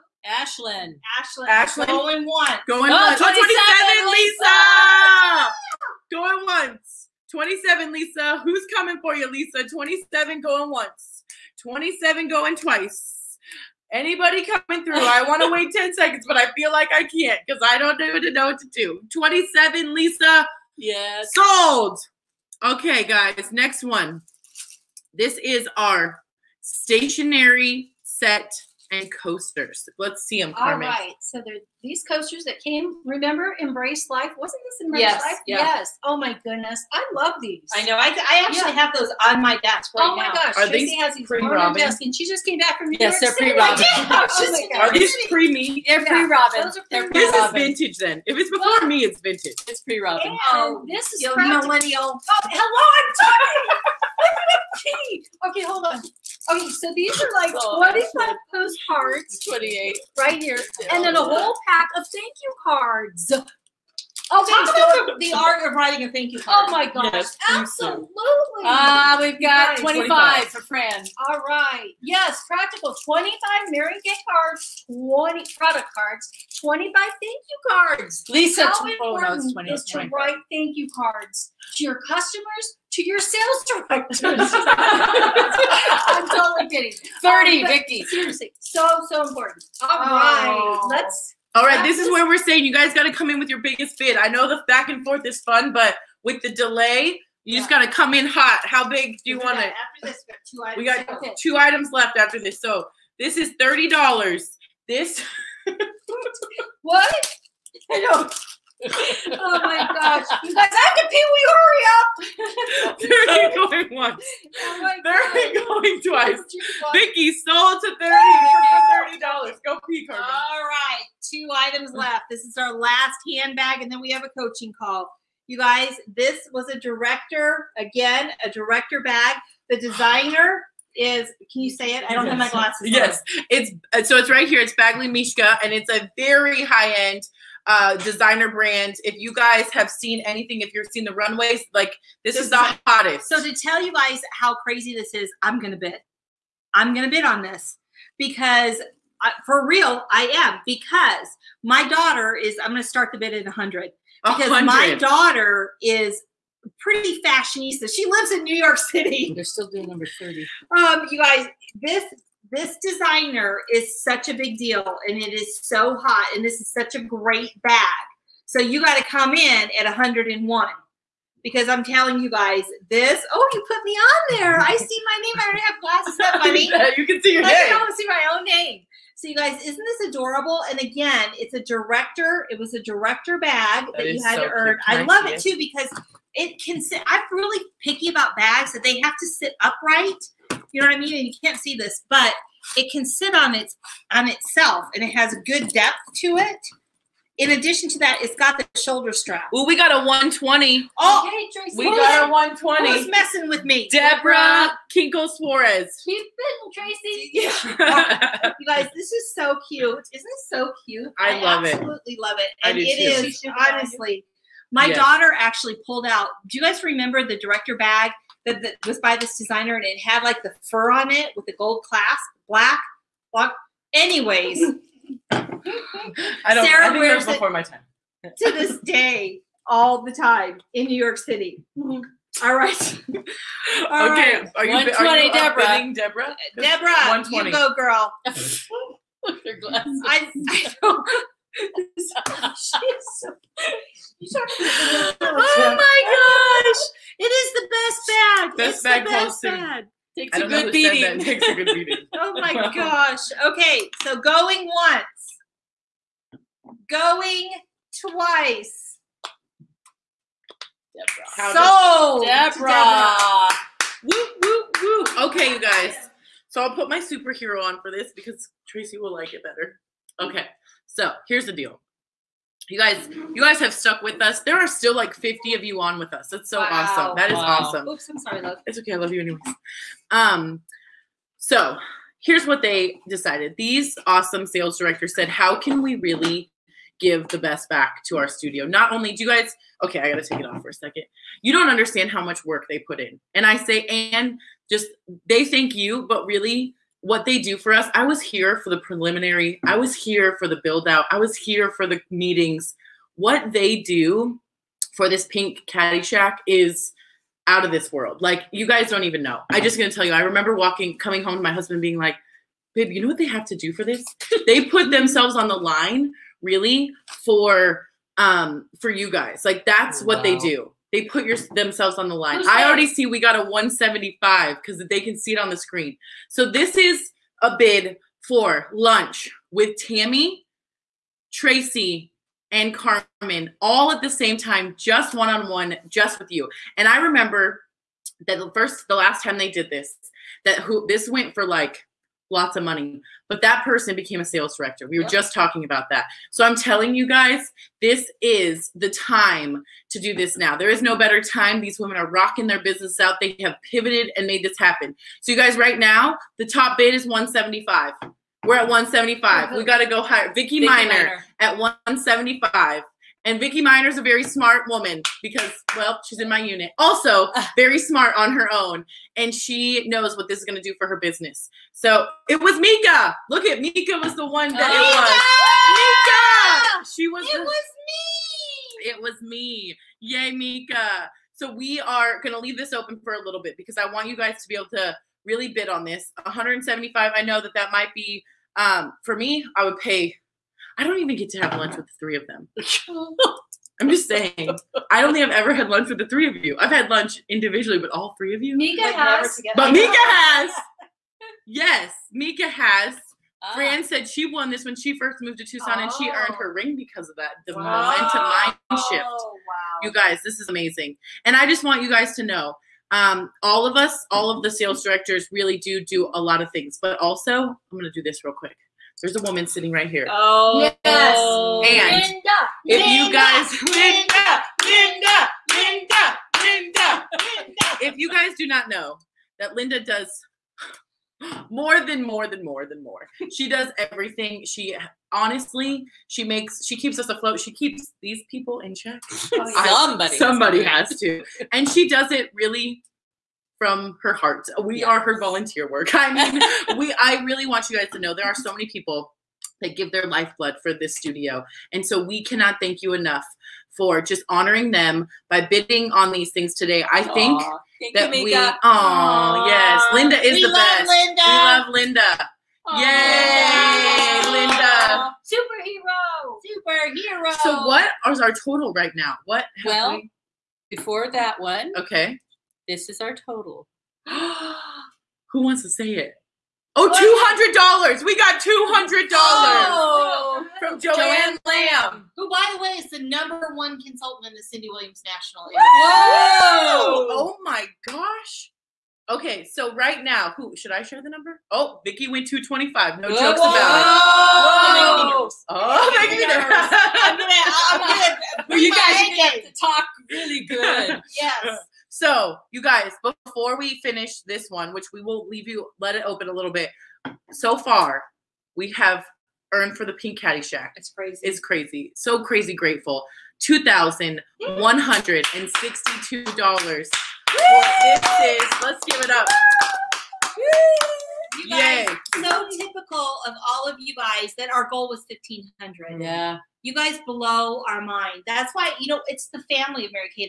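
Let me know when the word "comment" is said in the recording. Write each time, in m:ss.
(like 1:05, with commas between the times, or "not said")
not said.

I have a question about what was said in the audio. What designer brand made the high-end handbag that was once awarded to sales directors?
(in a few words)
Badgley Mischka.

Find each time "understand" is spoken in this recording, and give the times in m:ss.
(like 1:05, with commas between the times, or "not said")
4:51.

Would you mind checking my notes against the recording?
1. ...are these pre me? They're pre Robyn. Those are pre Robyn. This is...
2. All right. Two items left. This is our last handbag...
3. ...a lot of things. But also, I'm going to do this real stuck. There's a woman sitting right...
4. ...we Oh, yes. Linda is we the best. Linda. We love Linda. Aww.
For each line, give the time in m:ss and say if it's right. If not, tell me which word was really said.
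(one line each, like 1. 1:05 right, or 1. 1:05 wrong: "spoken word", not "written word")
1. 0:44 right
2. 2:00 right
3. 6:56 wrong: "quick", not "stuck"
4. 7:38 right.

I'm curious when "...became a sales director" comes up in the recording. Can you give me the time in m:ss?
5:43.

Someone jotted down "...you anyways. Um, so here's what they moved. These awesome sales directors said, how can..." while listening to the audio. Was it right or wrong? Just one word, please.
wrong.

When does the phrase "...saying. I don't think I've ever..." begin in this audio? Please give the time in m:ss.
6:34.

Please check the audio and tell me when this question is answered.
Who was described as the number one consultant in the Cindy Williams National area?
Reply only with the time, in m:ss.
8:00.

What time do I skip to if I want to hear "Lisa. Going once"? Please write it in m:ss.
0:05.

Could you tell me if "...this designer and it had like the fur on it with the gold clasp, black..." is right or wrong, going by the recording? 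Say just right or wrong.
right.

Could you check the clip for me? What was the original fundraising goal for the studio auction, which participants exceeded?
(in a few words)
1500.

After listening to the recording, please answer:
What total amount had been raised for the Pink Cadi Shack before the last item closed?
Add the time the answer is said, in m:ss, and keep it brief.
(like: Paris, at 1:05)
$2,162, at 8:33.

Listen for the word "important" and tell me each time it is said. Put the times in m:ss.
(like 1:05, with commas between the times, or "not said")
1:18, 1:29.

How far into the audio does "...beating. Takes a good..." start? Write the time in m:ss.
4:10.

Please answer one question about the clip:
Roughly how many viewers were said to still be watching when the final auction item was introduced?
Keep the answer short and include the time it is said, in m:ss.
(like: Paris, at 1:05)
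50, at 4:35.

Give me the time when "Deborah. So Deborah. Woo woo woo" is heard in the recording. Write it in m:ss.
4:20.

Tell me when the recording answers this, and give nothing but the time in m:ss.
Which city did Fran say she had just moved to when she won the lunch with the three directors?
6:45.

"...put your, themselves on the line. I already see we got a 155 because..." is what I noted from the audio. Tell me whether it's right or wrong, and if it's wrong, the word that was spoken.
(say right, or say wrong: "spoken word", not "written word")
wrong: "175", not "155".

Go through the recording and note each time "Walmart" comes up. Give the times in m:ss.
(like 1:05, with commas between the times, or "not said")
not said.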